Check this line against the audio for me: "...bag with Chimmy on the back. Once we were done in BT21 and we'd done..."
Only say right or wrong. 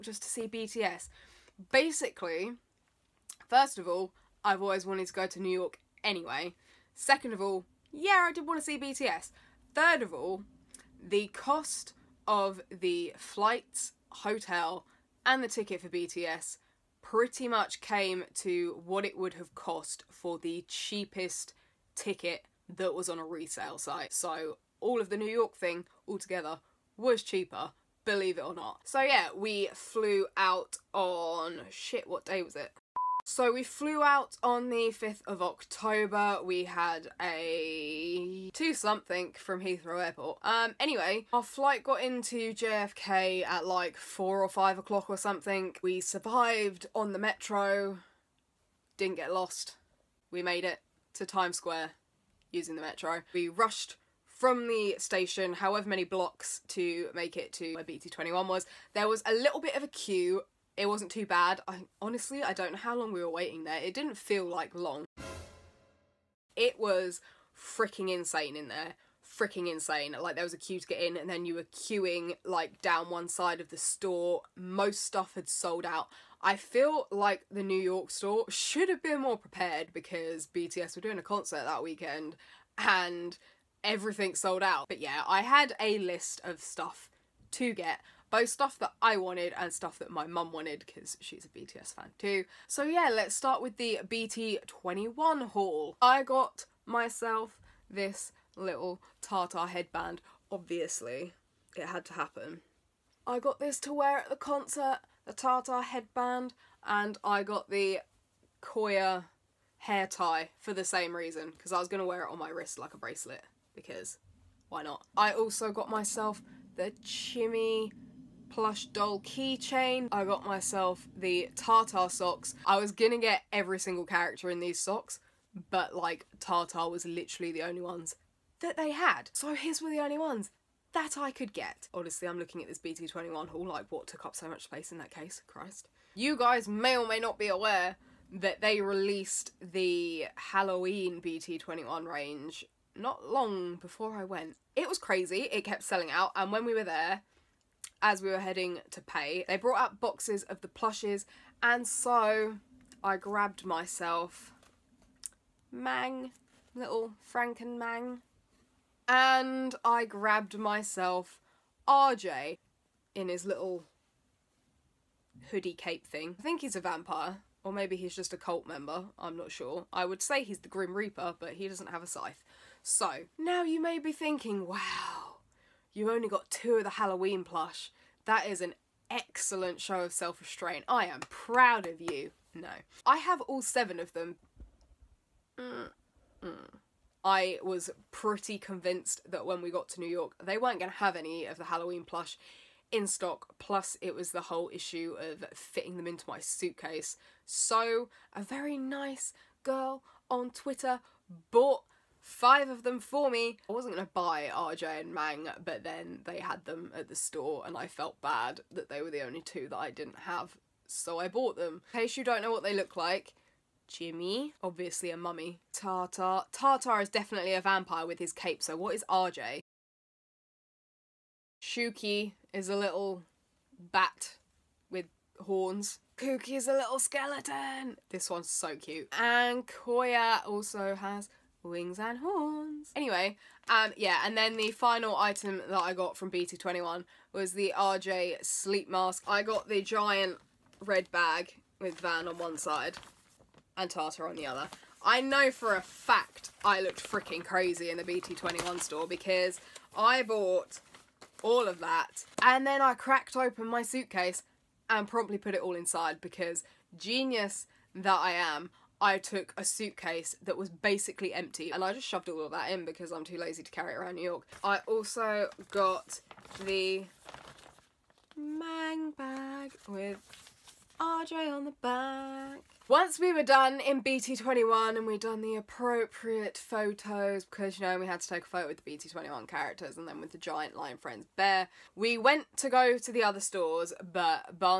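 wrong.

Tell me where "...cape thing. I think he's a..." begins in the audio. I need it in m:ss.
2:45.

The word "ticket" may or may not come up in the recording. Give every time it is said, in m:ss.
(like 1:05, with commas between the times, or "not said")
0:15, 0:21.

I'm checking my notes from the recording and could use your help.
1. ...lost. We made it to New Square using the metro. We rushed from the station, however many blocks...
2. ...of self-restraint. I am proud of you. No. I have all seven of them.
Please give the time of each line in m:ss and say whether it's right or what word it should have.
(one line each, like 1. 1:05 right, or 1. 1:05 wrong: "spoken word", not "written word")
1. 0:49 wrong: "Times", not "New"
2. 2:59 right.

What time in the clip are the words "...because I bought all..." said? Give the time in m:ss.
4:09.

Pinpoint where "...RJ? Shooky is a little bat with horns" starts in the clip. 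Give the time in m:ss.
3:39.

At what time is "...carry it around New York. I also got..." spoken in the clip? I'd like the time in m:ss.
4:23.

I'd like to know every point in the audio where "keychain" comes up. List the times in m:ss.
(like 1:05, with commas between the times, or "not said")
1:59.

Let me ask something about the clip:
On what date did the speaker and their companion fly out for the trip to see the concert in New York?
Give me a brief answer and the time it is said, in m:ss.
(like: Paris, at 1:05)
5th of October, at 0:34.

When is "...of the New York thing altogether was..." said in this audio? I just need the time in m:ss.
0:25.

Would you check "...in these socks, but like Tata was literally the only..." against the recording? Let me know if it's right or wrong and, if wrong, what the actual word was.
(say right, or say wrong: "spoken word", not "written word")
right.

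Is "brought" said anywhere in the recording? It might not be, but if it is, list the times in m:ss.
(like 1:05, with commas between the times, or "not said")
2:29.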